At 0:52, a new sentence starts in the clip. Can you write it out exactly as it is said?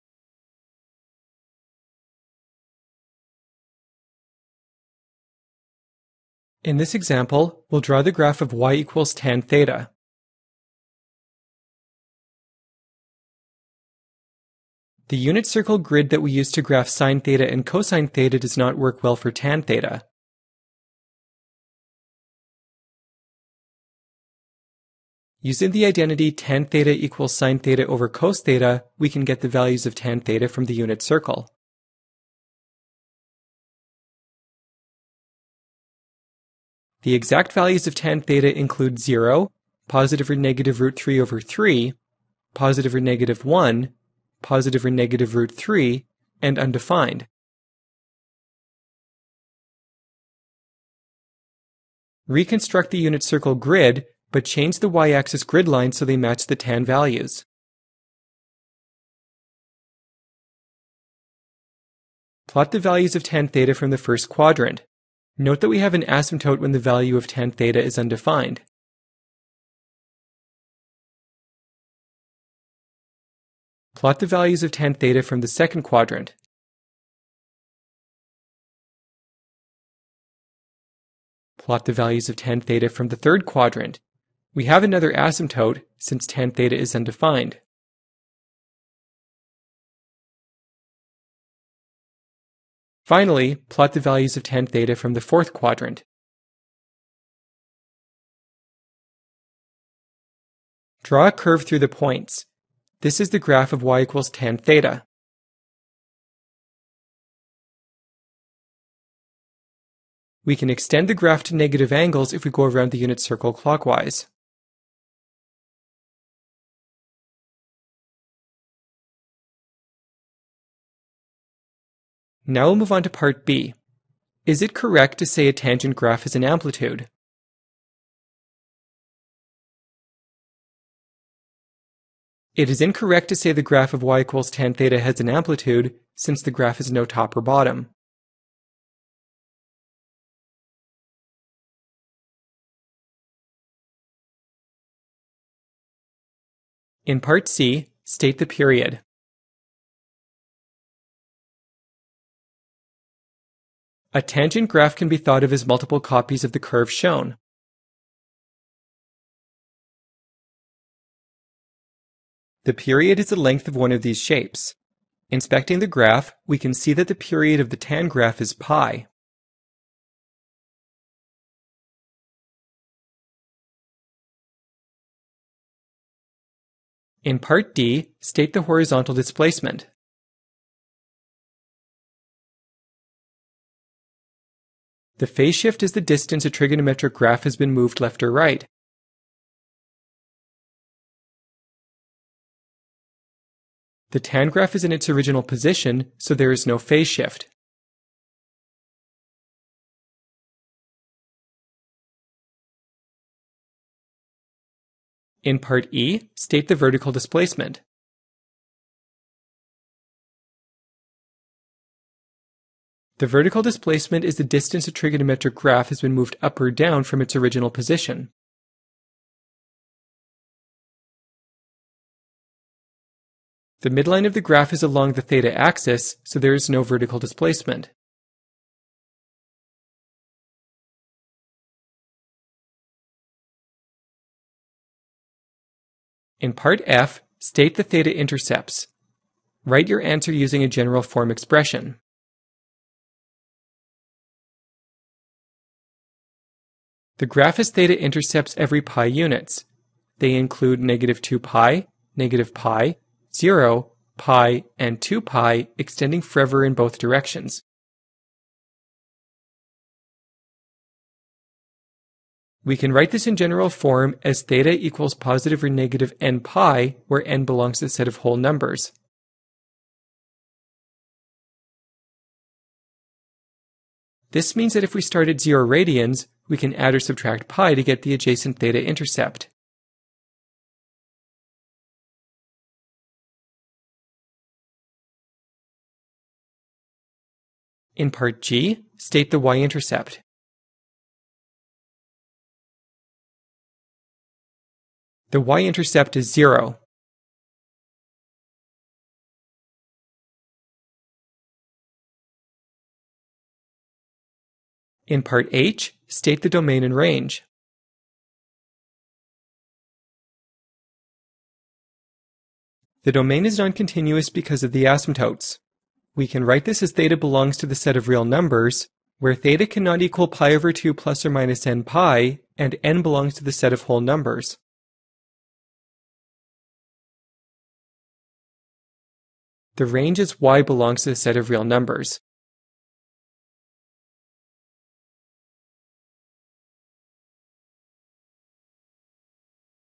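Reconstruct the unit circle grid, but change the y-axis grid line so they match the tan values.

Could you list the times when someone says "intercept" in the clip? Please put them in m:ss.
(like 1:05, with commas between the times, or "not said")
3:58, 4:08, 4:38, 4:49, 4:55.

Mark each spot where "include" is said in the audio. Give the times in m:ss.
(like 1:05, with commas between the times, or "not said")
0:38, 4:10.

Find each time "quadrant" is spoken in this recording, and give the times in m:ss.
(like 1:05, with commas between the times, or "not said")
1:04, 1:15, 1:23, 1:35.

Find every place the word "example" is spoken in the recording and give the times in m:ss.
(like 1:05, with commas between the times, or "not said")
0:06.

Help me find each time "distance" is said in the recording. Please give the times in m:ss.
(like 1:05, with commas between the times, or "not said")
3:06, 3:34.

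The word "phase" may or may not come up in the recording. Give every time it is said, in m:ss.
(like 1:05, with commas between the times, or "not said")
3:05, 3:16.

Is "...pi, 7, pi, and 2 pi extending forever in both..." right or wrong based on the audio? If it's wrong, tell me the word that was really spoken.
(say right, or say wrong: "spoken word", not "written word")
wrong: "0", not "7".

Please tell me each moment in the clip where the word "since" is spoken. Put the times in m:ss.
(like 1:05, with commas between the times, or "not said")
1:25, 2:16.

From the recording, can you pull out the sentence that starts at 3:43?
The midline of the graph is along the theta axis, so there is no vertical displacement.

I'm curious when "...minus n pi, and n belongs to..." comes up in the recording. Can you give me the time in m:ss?
5:21.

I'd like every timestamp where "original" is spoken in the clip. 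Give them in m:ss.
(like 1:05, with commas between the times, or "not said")
3:15, 3:37.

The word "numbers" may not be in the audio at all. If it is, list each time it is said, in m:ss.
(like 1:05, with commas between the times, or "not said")
4:28, 5:18, 5:24, 5:31.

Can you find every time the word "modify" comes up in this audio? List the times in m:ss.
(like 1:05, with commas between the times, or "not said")
not said.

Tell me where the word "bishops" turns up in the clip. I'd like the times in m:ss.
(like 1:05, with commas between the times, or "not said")
not said.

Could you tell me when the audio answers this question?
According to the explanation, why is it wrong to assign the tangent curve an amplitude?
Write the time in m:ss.
2:16.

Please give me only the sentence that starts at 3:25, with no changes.
In part E, state the vertical displacement.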